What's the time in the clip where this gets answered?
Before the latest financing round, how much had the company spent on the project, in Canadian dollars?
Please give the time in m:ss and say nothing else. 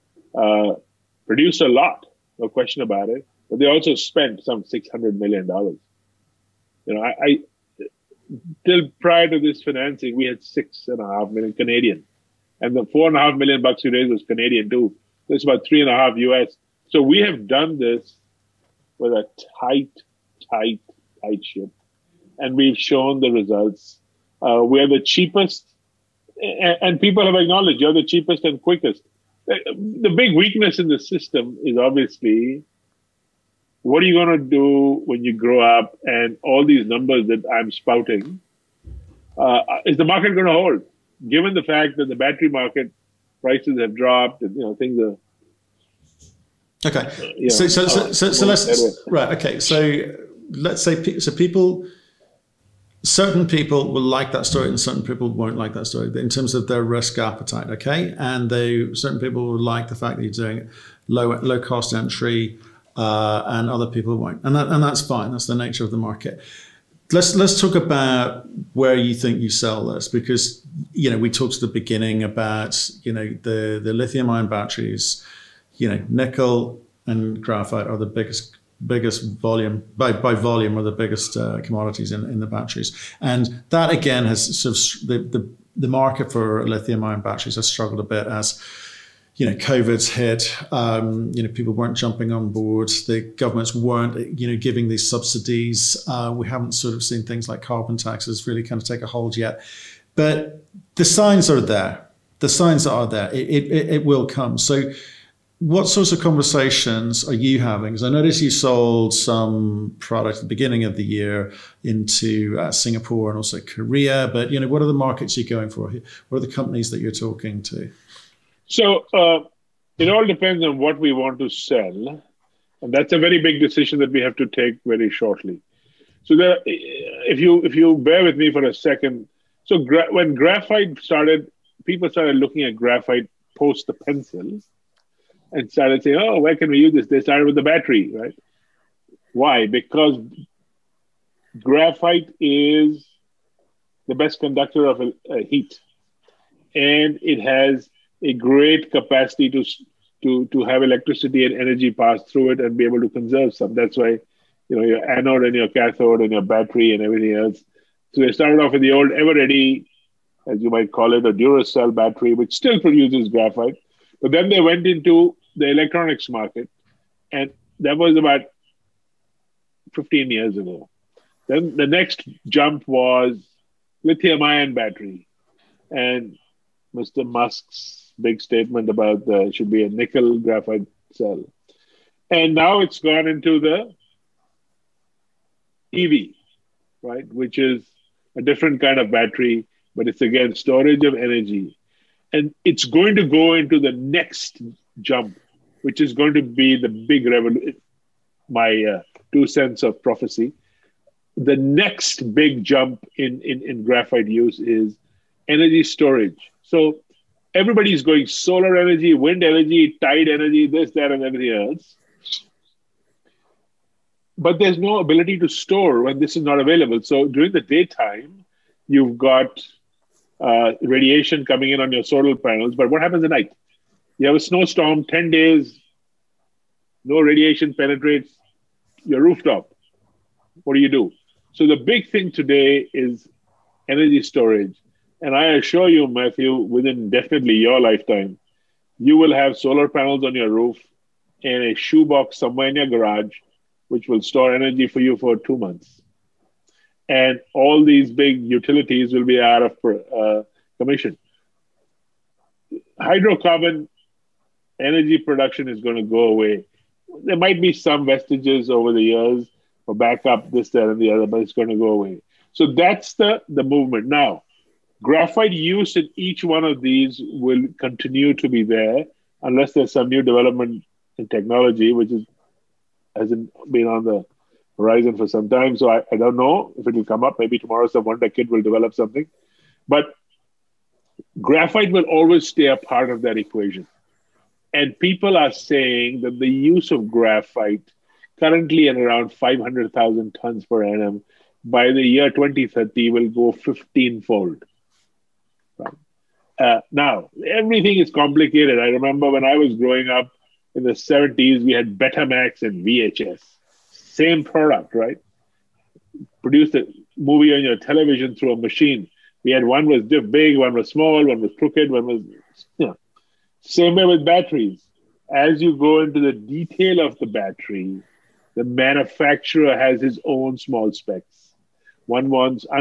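0:10.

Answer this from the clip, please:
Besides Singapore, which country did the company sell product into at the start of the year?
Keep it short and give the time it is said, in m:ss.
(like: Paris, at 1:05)
Korea, at 1:53.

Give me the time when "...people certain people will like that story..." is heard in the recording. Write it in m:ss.
0:51.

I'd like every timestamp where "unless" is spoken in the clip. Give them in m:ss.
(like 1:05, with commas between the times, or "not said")
4:29.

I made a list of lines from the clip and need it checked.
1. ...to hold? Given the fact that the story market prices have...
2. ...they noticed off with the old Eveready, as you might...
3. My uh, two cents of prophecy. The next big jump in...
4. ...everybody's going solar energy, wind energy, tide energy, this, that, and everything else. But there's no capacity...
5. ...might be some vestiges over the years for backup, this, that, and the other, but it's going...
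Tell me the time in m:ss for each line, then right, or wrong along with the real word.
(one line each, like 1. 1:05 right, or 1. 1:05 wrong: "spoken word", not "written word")
1. 0:40 wrong: "battery", not "story"
2. 2:38 wrong: "started", not "noticed"
3. 3:18 right
4. 3:27 wrong: "ability", not "capacity"
5. 4:17 right.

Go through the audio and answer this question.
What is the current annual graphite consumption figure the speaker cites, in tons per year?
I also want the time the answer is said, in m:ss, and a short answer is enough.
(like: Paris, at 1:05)
500,000 tons, at 4:49.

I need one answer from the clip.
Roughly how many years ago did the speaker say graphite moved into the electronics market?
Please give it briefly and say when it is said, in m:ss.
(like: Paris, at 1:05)
15 years, at 2:49.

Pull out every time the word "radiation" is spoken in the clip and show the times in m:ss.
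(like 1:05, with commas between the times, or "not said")
3:40, 3:47.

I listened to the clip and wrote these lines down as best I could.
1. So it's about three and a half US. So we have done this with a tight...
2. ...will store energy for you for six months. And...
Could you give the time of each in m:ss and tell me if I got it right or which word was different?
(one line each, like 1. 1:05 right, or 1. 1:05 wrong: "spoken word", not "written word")
1. 0:15 right
2. 4:04 wrong: "two", not "six".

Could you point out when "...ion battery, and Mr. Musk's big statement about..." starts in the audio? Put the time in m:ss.
2:54.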